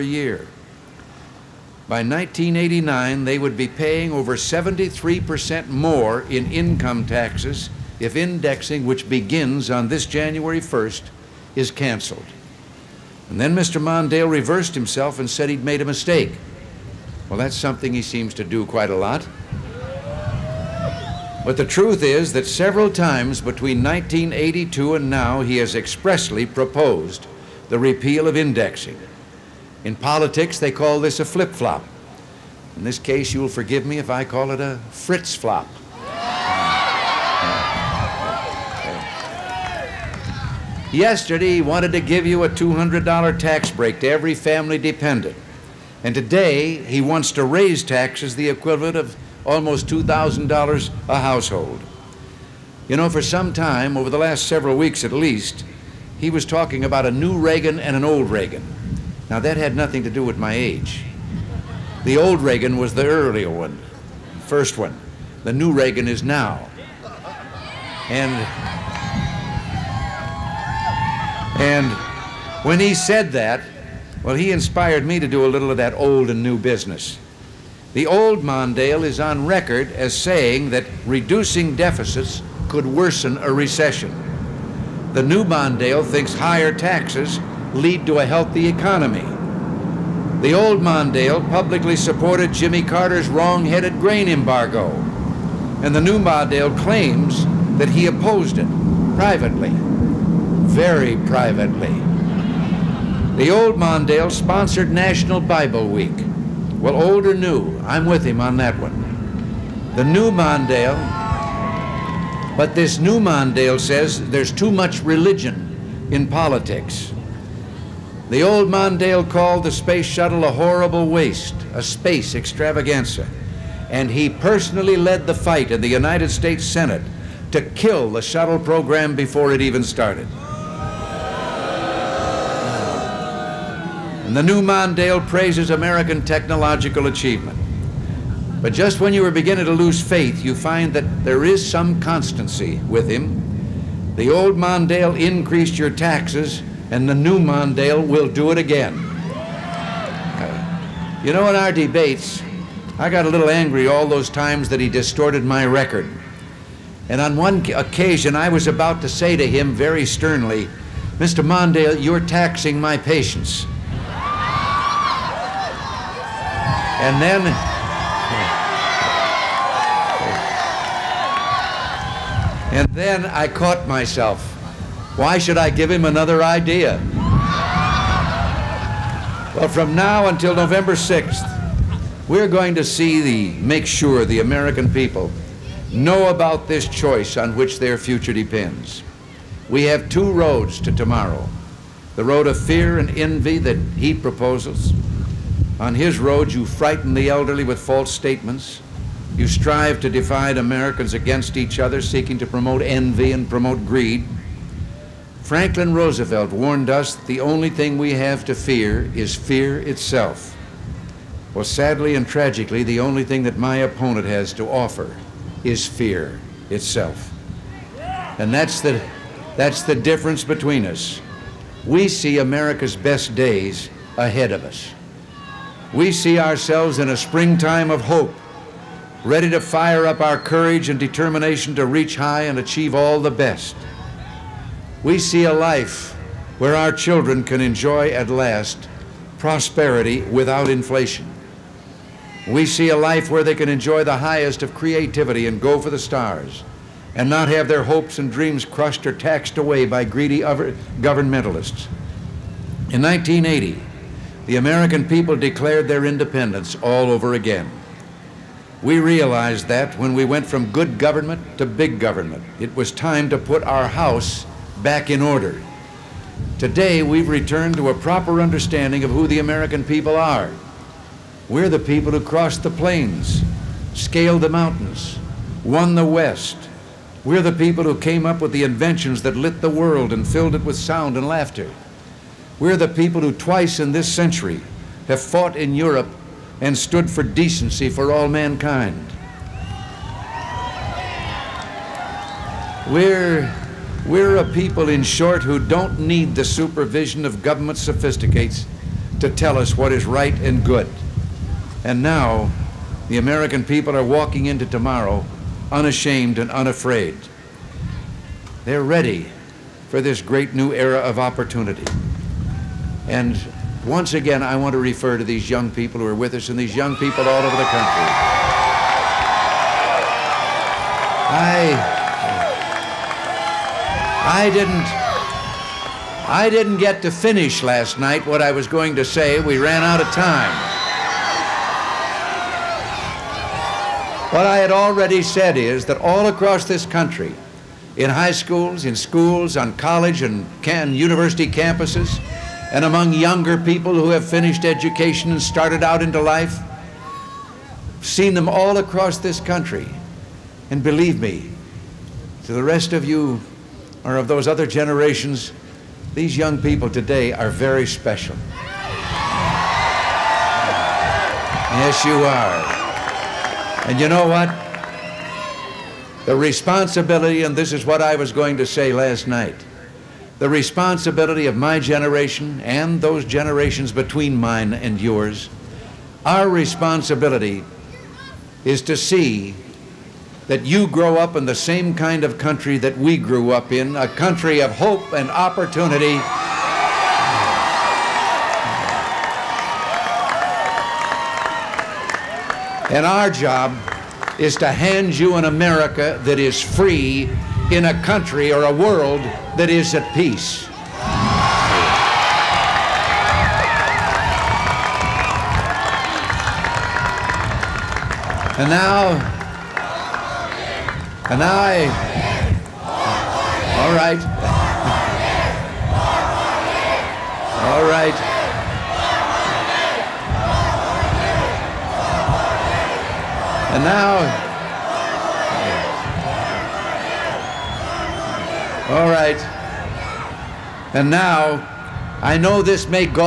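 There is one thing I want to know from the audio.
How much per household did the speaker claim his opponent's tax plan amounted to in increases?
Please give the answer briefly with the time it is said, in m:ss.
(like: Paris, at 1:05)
Almost $2,000, at 0:49.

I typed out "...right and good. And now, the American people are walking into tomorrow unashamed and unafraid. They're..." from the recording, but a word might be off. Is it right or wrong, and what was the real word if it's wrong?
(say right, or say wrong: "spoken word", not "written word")
right.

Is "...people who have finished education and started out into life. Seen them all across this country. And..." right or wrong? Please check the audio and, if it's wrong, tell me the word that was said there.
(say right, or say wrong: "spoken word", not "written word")
right.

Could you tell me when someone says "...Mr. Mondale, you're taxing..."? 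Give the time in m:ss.
2:41.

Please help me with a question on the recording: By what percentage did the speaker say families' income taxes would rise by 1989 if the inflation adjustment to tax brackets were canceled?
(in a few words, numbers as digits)
Over 73%.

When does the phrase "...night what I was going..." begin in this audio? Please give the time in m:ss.
5:27.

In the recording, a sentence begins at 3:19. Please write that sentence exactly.
You strive to divide Americans against each other, seeking to promote envy and promote greed.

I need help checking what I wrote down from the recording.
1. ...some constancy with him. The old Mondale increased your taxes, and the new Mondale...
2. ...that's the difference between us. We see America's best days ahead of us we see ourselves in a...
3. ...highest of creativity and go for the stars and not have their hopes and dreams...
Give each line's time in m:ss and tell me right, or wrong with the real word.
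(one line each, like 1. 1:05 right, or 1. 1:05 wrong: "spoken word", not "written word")
1. 2:21 right
2. 3:39 right
3. 4:04 right.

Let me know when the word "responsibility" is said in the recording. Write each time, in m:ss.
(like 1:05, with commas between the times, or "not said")
6:06, 6:10, 6:16.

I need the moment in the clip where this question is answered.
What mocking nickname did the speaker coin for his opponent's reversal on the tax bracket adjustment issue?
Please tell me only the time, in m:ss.
0:34.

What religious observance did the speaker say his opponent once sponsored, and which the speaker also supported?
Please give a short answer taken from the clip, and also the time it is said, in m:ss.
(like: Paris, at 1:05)
National Bible Week, at 1:44.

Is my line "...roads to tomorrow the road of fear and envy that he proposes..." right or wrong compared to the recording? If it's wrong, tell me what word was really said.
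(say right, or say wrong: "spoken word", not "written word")
right.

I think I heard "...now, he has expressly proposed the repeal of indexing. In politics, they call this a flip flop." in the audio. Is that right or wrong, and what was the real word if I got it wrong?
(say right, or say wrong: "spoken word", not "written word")
right.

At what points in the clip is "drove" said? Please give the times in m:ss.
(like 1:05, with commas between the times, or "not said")
not said.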